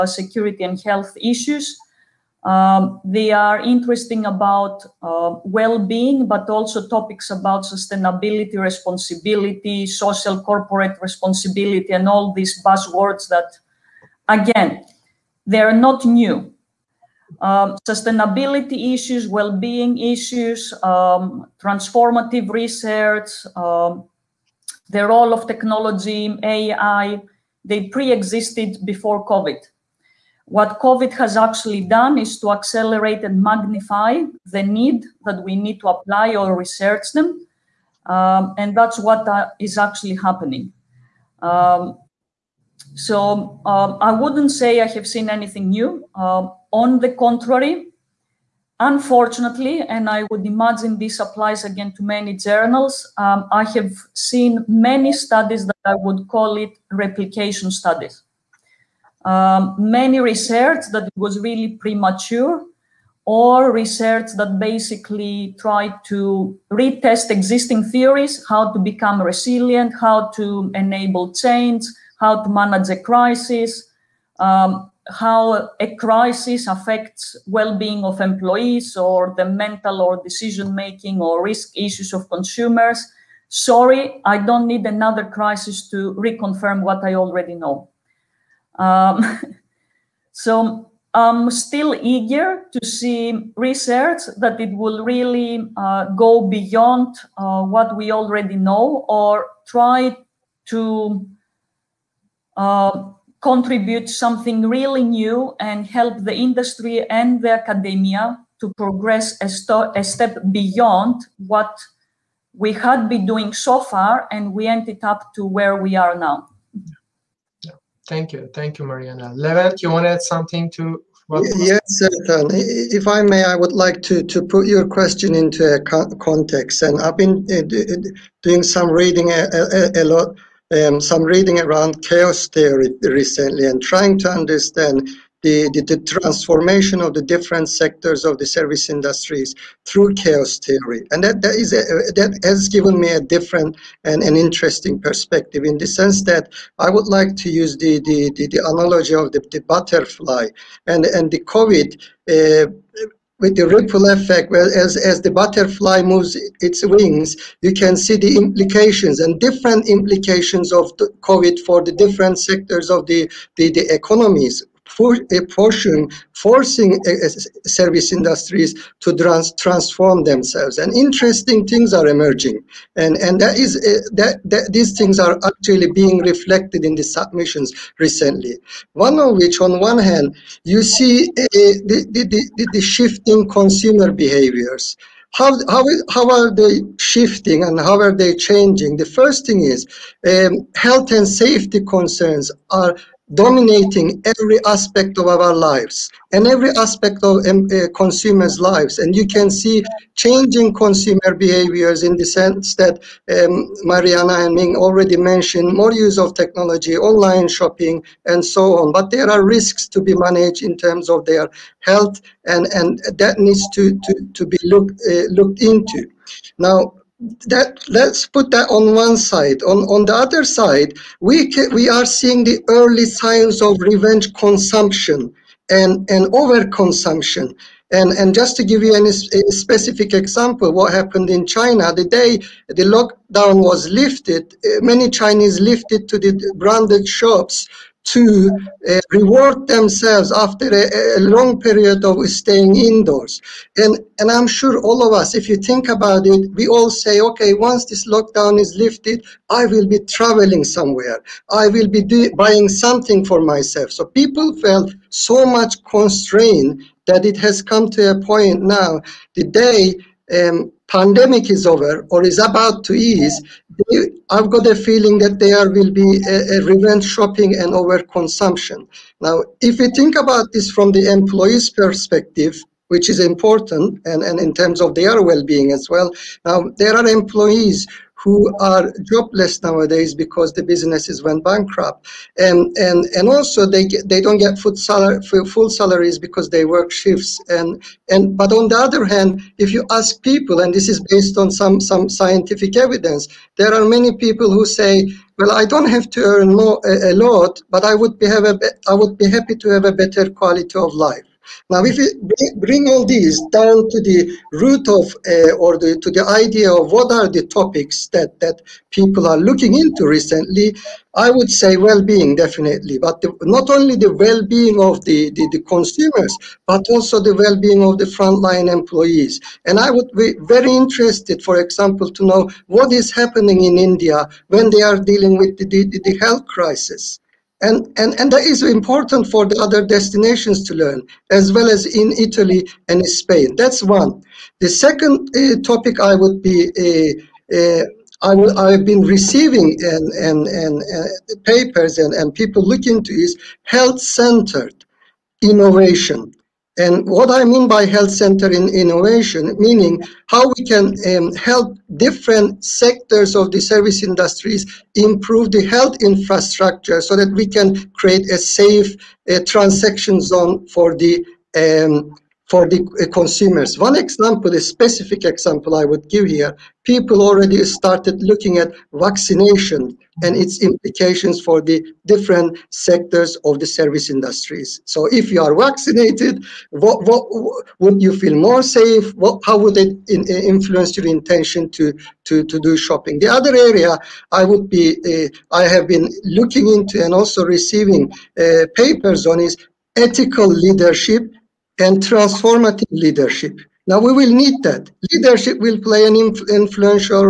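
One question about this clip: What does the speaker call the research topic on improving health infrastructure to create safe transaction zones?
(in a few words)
Health-centered innovation.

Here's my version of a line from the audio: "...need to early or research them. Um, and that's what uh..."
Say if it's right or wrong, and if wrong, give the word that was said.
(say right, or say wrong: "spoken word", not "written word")
wrong: "apply", not "early".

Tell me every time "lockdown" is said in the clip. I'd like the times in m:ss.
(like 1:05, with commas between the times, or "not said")
3:52, 4:08.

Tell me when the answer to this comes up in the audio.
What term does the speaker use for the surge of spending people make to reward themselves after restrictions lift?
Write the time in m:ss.
3:43.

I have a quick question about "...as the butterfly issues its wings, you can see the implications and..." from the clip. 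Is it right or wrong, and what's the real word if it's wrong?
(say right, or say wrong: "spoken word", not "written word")
wrong: "moves", not "issues".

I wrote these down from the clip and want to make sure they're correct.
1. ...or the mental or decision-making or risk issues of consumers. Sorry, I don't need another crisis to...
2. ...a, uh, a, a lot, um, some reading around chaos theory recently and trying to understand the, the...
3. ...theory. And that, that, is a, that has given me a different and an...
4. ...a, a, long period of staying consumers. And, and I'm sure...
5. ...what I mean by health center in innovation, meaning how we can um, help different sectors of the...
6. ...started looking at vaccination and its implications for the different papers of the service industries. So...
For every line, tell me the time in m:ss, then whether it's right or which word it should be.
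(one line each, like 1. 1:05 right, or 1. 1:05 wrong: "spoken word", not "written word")
1. 1:18 right
2. 2:09 right
3. 2:20 right
4. 4:00 wrong: "indoors", not "consumers"
5. 5:47 right
6. 6:07 wrong: "sectors", not "papers".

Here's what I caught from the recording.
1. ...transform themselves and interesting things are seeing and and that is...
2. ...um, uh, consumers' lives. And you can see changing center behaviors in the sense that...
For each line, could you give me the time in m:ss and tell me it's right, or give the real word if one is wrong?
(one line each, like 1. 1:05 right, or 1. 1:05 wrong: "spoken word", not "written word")
1. 2:49 wrong: "emerging", not "seeing"
2. 3:17 wrong: "consumer", not "center".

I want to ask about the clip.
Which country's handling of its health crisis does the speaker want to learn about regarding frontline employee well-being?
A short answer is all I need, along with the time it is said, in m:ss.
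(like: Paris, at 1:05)
India, at 5:23.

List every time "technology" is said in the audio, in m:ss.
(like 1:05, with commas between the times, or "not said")
0:25, 3:26.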